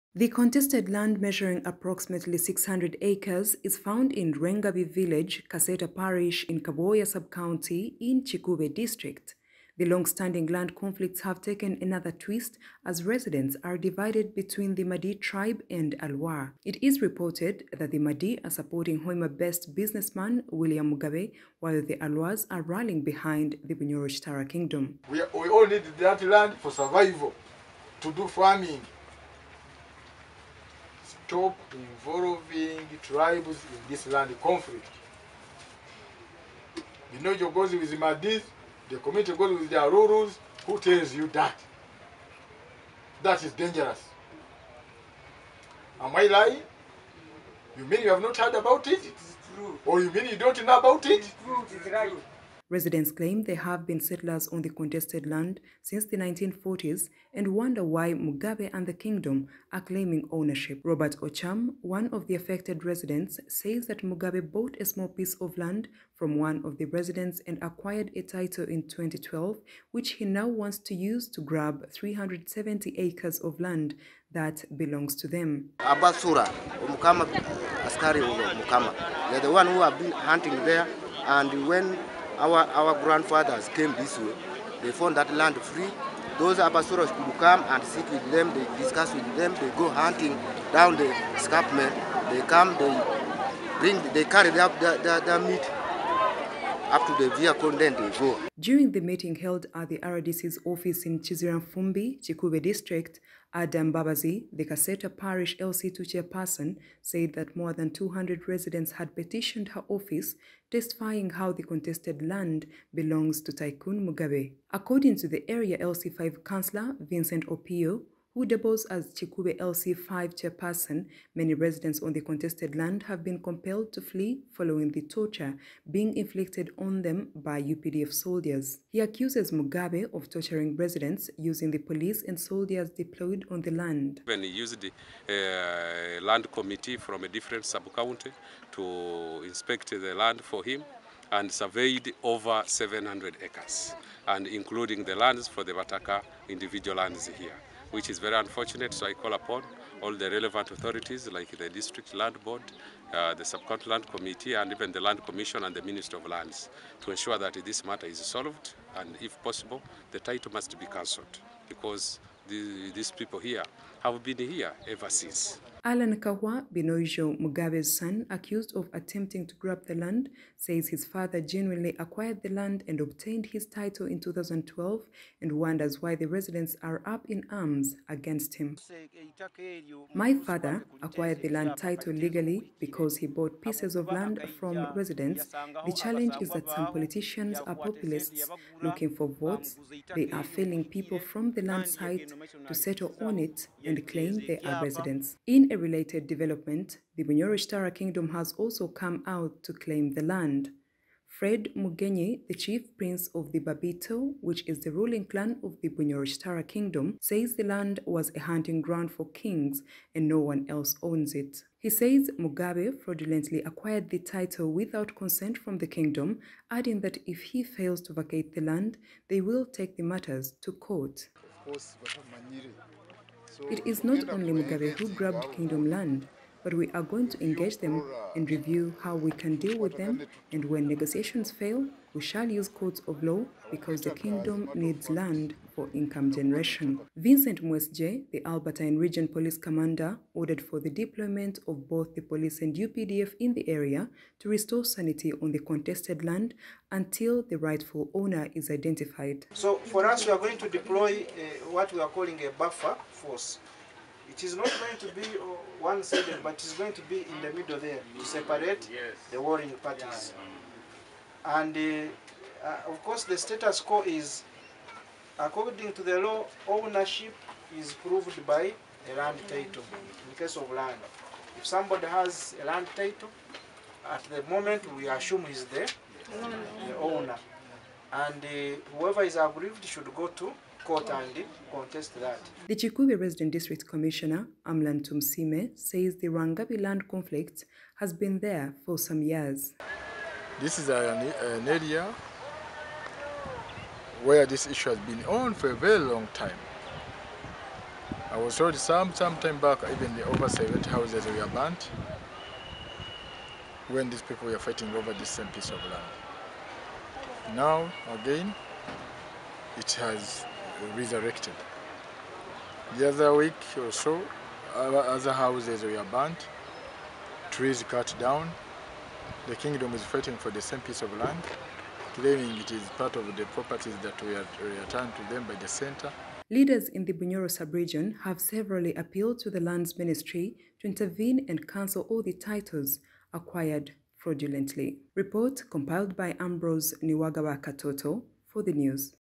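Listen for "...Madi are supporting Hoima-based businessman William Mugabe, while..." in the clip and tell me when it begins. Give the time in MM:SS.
00:17.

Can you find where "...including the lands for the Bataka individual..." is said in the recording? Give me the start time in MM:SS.
02:24.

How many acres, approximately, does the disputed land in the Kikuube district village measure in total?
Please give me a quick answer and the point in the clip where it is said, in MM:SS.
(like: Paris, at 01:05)
600, at 00:02.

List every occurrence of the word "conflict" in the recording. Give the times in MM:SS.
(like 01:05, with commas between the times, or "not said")
00:10, 00:34, 04:47.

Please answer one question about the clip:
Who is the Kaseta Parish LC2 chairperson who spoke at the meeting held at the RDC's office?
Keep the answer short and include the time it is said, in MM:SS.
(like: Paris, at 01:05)
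Adam Babazi, at 01:43.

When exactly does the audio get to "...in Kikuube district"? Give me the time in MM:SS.
00:08.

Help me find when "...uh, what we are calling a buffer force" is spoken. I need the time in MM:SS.
04:11.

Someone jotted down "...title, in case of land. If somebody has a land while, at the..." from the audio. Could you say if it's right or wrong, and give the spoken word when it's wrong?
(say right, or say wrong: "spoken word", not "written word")
wrong: "title", not "while".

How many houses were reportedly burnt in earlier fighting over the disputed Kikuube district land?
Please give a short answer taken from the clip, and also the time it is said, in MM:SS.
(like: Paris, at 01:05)
Over 70, at 05:00.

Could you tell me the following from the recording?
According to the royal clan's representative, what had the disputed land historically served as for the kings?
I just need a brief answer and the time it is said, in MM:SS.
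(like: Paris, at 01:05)
A hunting ground, at 03:28.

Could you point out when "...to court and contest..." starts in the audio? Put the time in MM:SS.
04:40.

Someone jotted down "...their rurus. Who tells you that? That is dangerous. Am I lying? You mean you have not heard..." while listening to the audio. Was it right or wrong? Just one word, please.
right.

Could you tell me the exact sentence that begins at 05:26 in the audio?
Leaders in the Bunyoro sub-region have severally appealed to the Lands Ministry to intervene and cancel all the titles acquired fraudulently.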